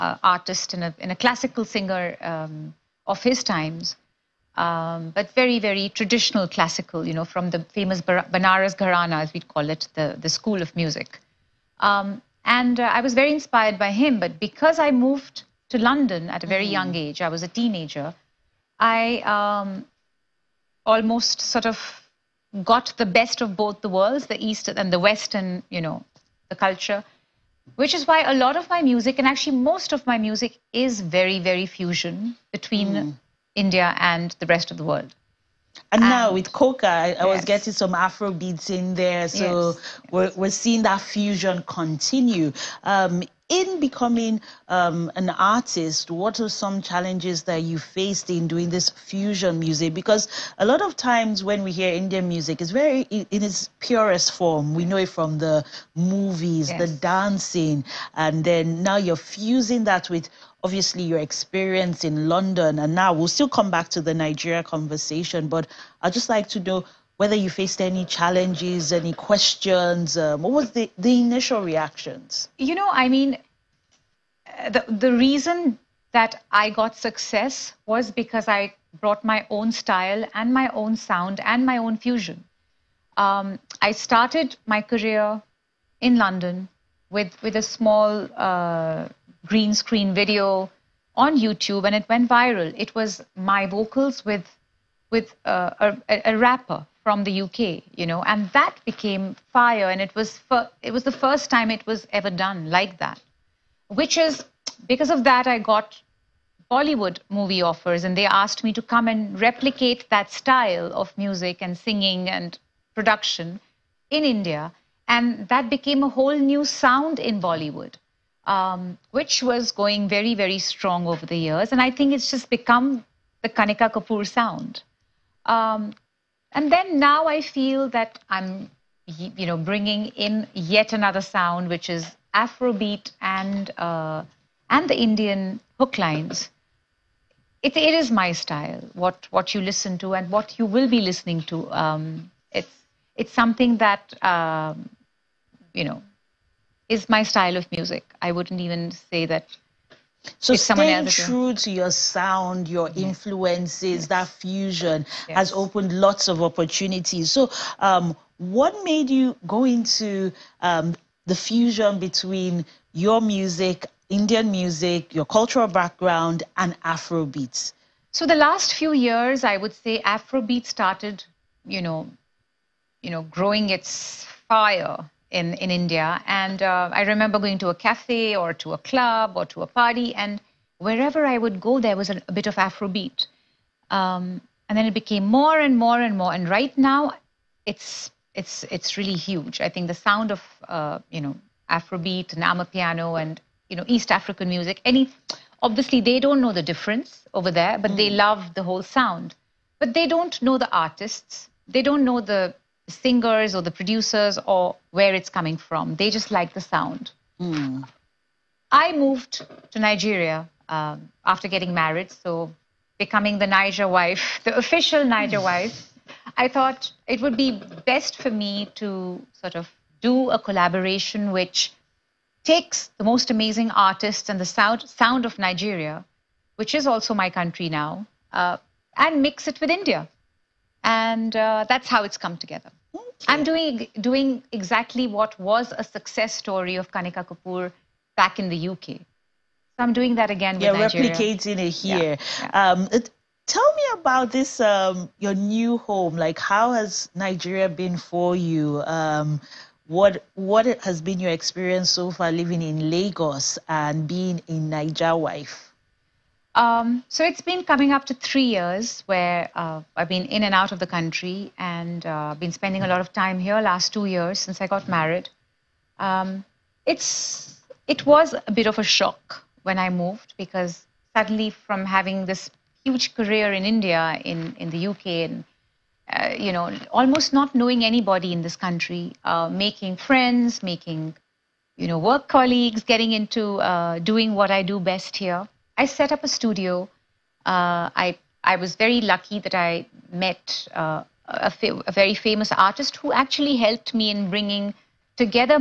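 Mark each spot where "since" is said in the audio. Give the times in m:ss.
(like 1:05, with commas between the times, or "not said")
4:24.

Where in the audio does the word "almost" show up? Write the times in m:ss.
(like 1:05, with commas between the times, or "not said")
0:20, 4:36.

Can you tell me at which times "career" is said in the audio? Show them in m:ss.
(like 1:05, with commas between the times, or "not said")
1:24, 4:33.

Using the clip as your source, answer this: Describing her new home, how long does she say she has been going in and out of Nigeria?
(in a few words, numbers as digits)
3 years.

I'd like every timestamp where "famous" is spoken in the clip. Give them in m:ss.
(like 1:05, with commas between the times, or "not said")
0:07, 4:52.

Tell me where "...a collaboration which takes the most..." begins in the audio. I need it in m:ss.
3:40.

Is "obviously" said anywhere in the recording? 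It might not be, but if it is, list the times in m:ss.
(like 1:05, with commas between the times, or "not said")
1:00, 3:15.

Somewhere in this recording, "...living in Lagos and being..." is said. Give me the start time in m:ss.
4:12.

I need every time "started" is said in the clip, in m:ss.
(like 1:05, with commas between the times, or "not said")
1:23, 2:50.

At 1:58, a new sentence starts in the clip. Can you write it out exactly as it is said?
Um, which was going very, very strong over the years.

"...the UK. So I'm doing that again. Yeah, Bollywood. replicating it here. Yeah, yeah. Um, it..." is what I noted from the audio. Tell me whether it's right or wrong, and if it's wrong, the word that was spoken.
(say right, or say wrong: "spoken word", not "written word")
wrong: "Nigeria", not "Bollywood".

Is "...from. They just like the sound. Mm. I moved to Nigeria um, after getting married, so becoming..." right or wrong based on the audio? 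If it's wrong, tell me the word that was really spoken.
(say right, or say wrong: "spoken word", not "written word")
right.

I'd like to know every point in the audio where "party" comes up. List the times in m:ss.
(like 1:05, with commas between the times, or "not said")
2:59.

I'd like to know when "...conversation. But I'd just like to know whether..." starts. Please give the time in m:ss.
1:04.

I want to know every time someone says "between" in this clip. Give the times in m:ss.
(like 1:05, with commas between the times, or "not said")
0:32, 2:41.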